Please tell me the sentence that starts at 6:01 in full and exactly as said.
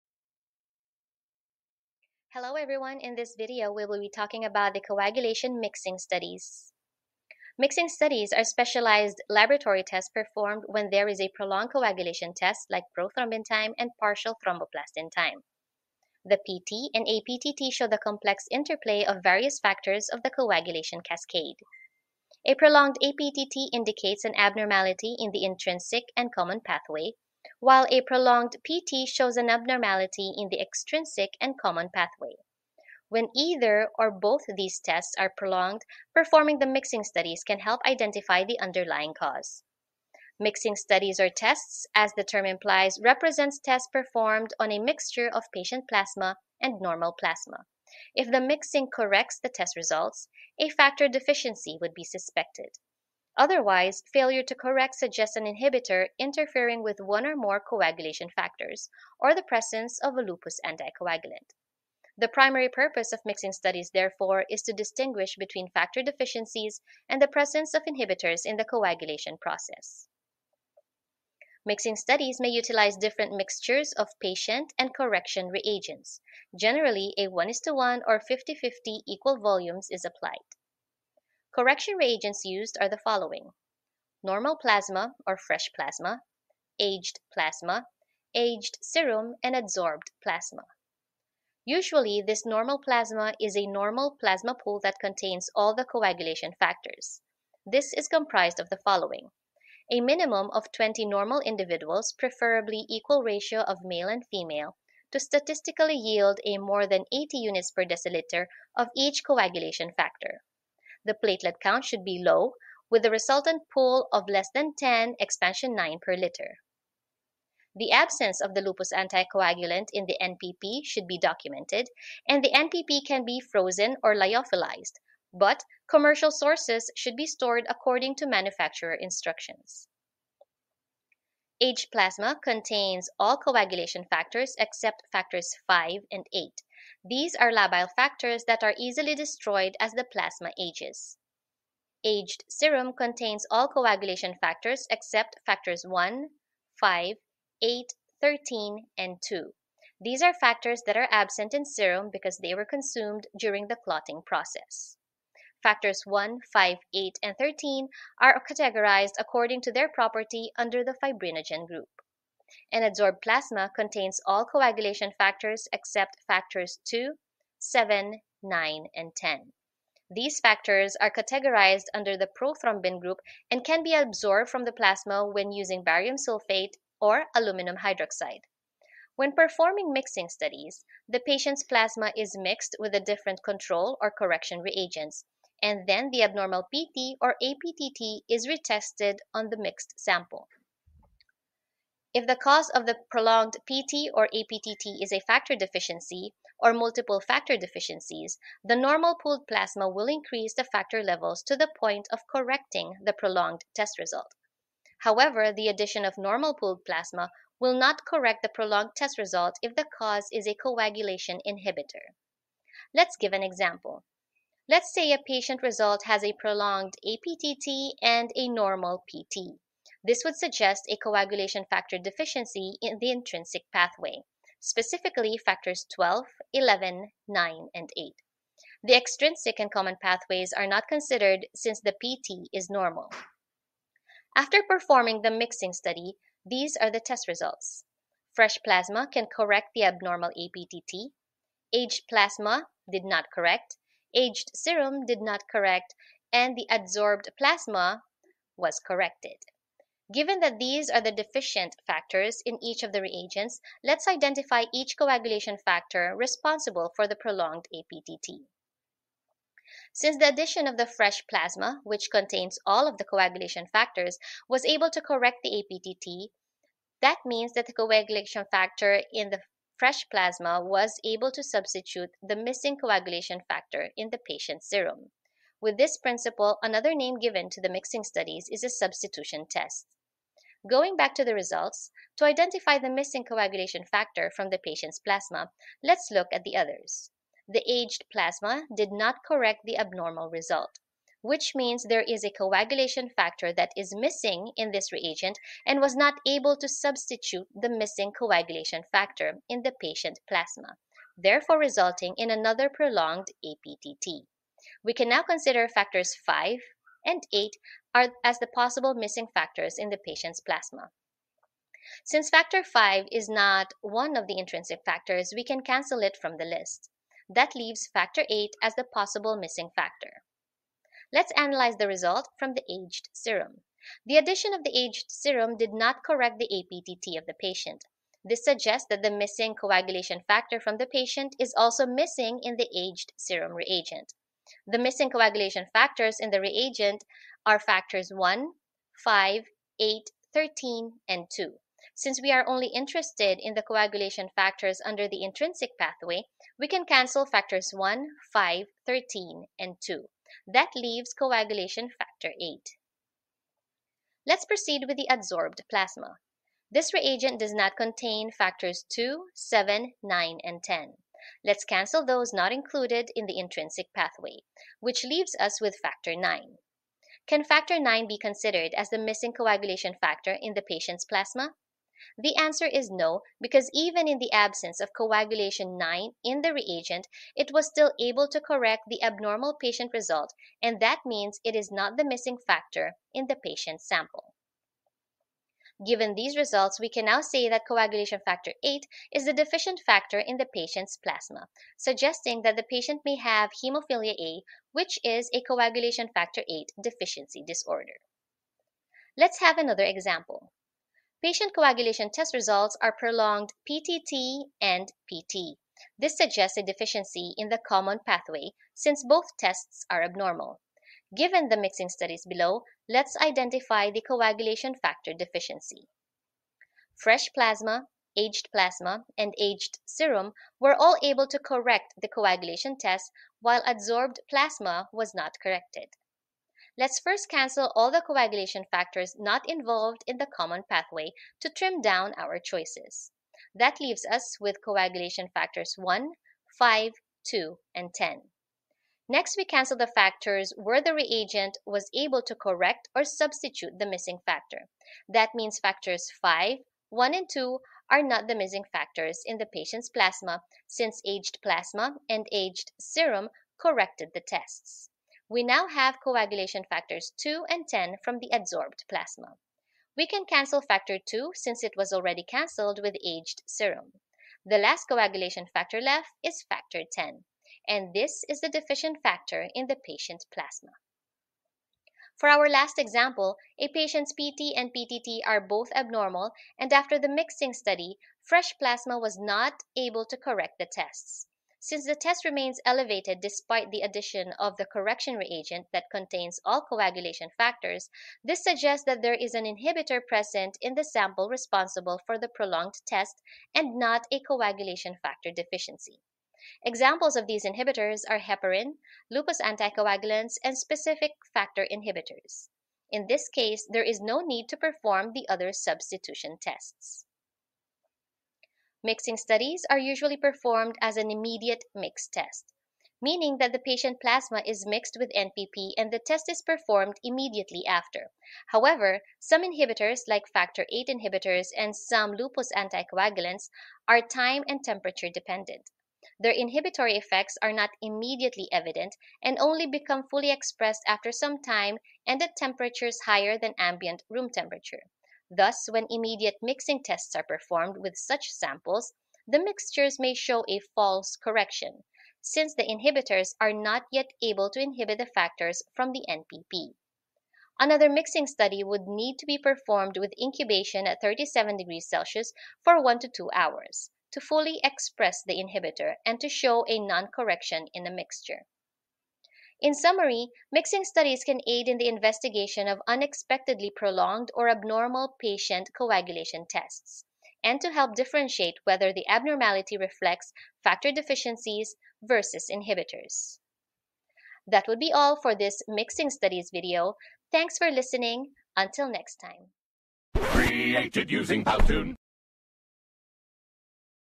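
Let's cancel those not included in the intrinsic pathway, which leaves us with factor 9.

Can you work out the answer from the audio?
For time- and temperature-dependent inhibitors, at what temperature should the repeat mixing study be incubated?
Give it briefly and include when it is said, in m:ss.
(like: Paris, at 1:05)
37 degrees Celsius, at 9:10.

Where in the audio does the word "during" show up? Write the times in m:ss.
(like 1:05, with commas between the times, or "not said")
2:33.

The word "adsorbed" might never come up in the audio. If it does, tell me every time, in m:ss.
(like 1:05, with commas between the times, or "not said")
1:29, 2:42, 4:06, 5:55, 7:03, 7:38.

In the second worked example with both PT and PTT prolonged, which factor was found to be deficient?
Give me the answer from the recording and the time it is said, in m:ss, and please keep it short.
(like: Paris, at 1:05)
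factor 10, at 7:46.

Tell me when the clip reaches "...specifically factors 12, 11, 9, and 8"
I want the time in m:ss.
3:44.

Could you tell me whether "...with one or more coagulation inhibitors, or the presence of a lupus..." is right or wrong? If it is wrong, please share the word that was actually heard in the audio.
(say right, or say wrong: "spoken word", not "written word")
wrong: "factors", not "inhibitors".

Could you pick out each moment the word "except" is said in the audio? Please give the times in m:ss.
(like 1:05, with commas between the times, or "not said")
2:14, 2:24, 2:45.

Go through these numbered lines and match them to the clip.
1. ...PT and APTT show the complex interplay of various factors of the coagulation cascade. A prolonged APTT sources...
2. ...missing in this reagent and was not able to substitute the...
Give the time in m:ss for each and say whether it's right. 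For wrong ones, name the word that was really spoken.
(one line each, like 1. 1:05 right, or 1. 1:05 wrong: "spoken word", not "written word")
1. 0:16 wrong: "indicates", not "sources"
2. 4:53 right.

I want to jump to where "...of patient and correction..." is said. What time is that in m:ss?
1:13.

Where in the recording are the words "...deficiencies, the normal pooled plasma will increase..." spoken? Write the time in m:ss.
3:17.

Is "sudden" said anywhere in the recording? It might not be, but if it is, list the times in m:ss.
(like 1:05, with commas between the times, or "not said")
not said.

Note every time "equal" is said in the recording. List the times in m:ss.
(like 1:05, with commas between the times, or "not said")
1:19, 1:42.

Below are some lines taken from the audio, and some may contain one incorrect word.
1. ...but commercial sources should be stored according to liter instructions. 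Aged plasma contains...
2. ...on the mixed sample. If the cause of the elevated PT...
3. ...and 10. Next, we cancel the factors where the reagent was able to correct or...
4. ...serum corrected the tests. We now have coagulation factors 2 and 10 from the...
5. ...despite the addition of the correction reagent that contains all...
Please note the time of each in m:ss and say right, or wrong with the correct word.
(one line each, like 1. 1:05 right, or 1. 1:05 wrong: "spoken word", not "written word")
1. 2:05 wrong: "manufacturer", not "liter"
2. 3:09 wrong: "prolonged", not "elevated"
3. 7:17 right
4. 7:32 right
5. 8:03 right.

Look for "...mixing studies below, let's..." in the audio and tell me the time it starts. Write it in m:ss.
6:51.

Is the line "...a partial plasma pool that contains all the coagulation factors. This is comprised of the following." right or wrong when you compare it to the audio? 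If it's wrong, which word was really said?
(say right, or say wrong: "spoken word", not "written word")
wrong: "normal", not "partial".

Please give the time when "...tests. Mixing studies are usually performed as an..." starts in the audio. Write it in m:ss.
8:26.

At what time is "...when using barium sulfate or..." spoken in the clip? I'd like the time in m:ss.
2:55.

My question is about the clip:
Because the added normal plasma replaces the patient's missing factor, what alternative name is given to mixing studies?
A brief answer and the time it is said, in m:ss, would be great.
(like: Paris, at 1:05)
substitution test, at 4:38.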